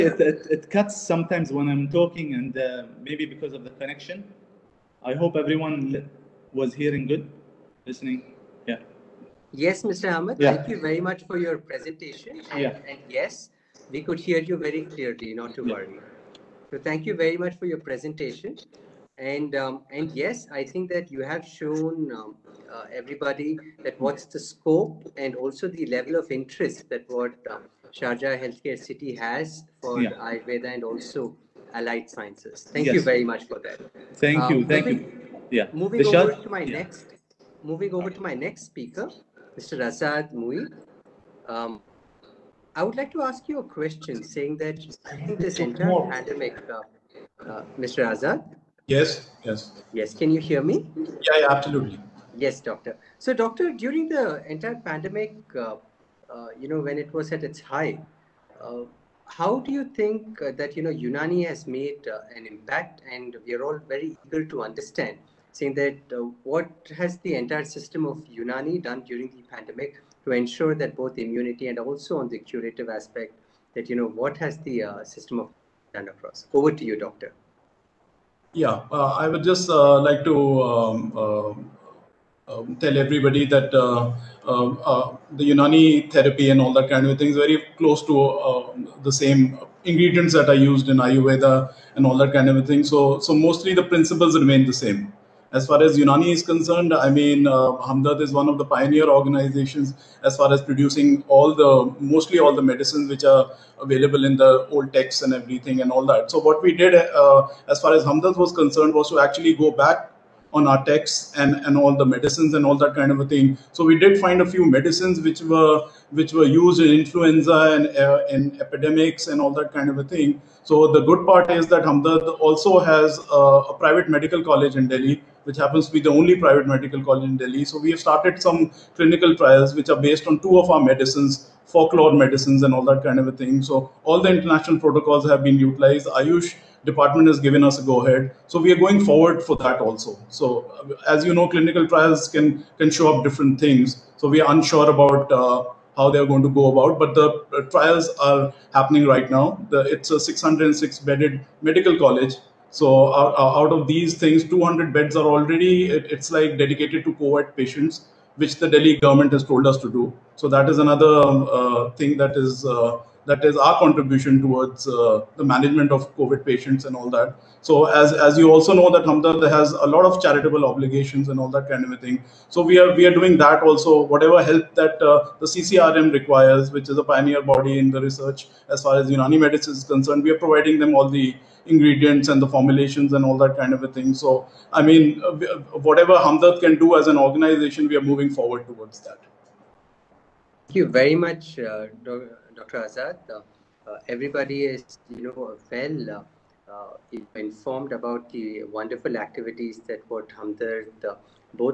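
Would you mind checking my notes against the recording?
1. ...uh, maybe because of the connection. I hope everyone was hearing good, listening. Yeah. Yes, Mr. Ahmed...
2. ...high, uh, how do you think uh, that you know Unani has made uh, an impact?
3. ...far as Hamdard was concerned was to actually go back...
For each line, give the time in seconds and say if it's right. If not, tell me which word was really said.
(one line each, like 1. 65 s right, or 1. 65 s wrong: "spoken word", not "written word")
1. 2 s right
2. 57 s right
3. 107 s right.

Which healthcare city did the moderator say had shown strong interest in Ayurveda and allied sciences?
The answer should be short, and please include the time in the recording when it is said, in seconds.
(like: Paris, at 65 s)
Sharjah Healthcare City, at 27 s.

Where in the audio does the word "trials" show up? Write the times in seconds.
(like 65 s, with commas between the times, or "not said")
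129 s, 141 s, 147 s.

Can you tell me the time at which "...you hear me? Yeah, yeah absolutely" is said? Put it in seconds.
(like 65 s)
50 s.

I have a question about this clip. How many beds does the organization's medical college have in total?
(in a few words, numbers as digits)
606.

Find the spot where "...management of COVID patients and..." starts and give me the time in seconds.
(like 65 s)
165 s.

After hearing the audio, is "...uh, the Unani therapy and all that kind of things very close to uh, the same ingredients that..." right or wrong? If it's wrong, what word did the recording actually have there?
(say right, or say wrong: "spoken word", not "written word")
right.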